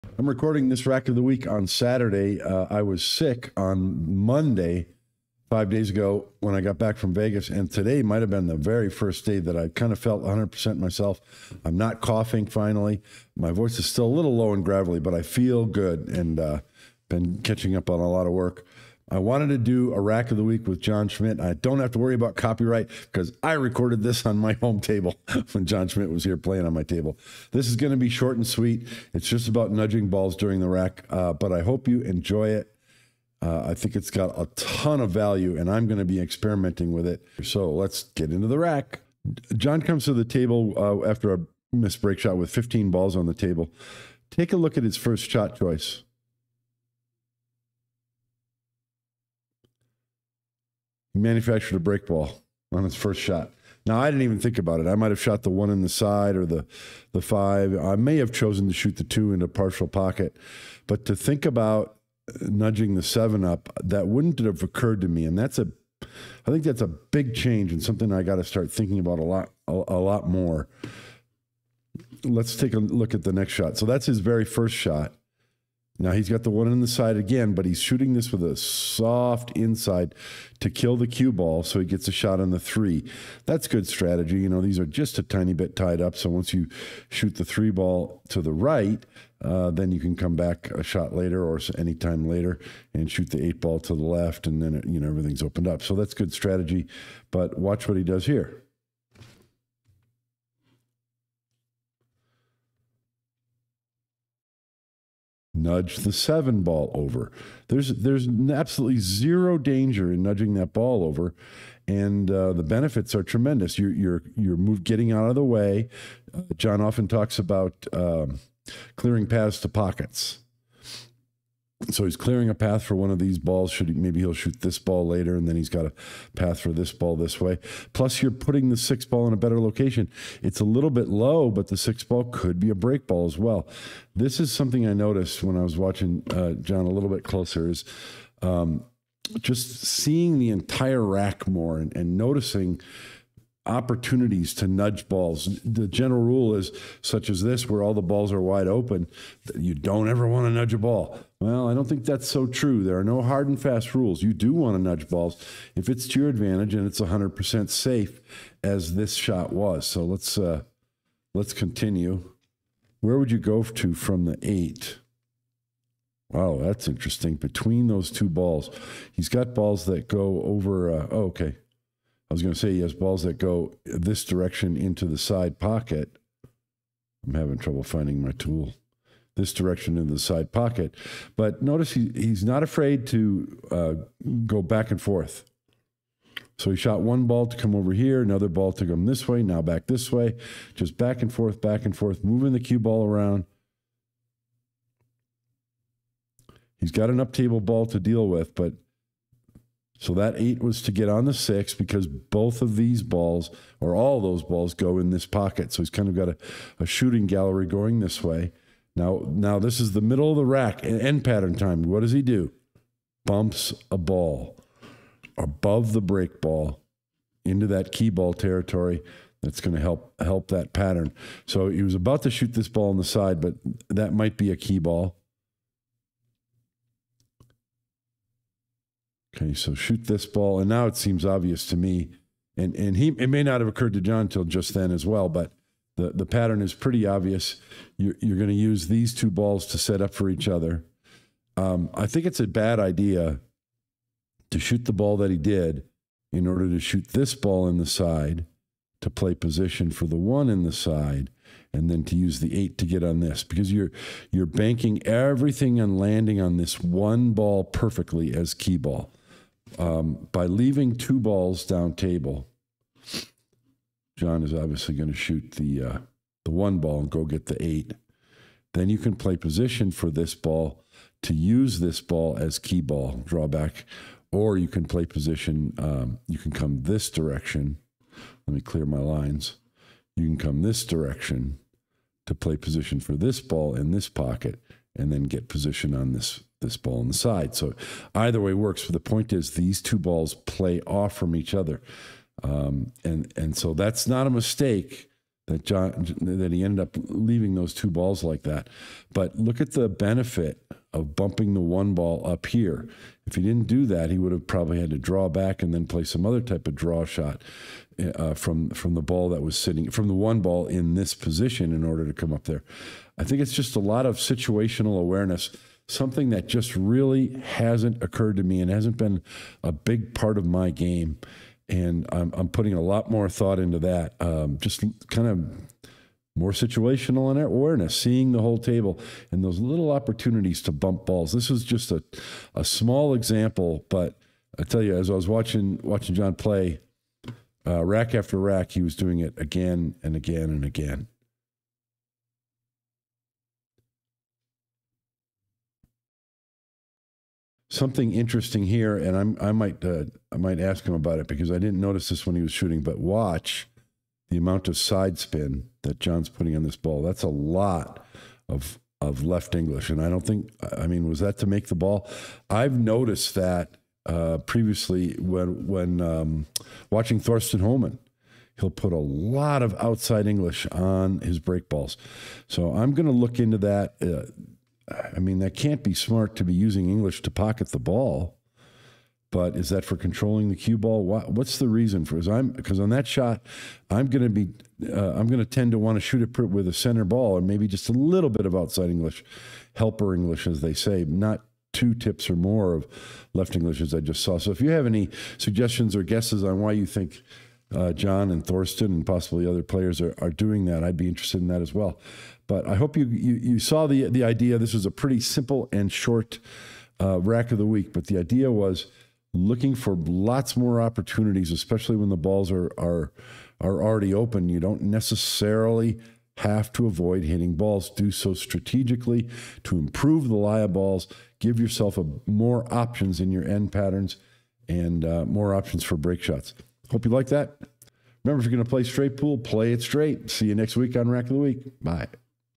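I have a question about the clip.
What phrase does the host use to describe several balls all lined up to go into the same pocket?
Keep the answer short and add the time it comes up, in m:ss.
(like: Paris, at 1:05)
Shooting gallery, at 3:26.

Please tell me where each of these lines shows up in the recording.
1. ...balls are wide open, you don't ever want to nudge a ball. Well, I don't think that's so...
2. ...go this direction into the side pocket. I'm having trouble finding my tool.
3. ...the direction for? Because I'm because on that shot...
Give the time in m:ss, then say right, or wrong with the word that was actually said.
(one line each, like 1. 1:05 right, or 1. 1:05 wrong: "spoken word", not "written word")
1. 2:28 right
2. 2:53 right
3. 6:21 wrong: "reason", not "direction".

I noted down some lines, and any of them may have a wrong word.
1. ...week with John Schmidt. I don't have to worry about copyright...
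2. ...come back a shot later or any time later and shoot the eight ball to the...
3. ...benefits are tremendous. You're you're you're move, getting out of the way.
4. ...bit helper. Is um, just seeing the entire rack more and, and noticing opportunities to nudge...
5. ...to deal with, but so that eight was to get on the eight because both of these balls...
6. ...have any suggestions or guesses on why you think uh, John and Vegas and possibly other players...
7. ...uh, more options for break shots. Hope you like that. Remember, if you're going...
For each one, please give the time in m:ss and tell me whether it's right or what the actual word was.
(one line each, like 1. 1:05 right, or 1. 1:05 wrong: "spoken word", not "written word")
1. 0:20 right
2. 1:30 right
3. 1:52 right
4. 2:17 wrong: "closer", not "helper"
5. 3:17 wrong: "six", not "eight"
6. 6:34 wrong: "Thorsten", not "Vegas"
7. 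7:05 right.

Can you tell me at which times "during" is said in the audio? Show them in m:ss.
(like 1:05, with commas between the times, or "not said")
0:30.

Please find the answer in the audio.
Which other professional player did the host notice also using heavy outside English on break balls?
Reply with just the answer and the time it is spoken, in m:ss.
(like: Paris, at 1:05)
Thorsten Hohmann, at 6:07.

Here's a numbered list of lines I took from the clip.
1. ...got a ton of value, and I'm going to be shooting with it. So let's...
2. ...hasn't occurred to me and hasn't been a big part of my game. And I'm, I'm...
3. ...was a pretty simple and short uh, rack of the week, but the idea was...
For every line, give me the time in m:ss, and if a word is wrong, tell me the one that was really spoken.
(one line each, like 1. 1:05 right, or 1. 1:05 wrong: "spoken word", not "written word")
1. 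0:34 wrong: "experimenting", not "shooting"
2. 5:17 right
3. 6:44 right.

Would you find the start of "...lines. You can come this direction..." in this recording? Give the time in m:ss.
4:38.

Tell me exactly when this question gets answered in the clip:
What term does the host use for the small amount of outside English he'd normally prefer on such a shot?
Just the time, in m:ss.
6:29.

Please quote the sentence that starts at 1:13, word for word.
So that's his very first shot.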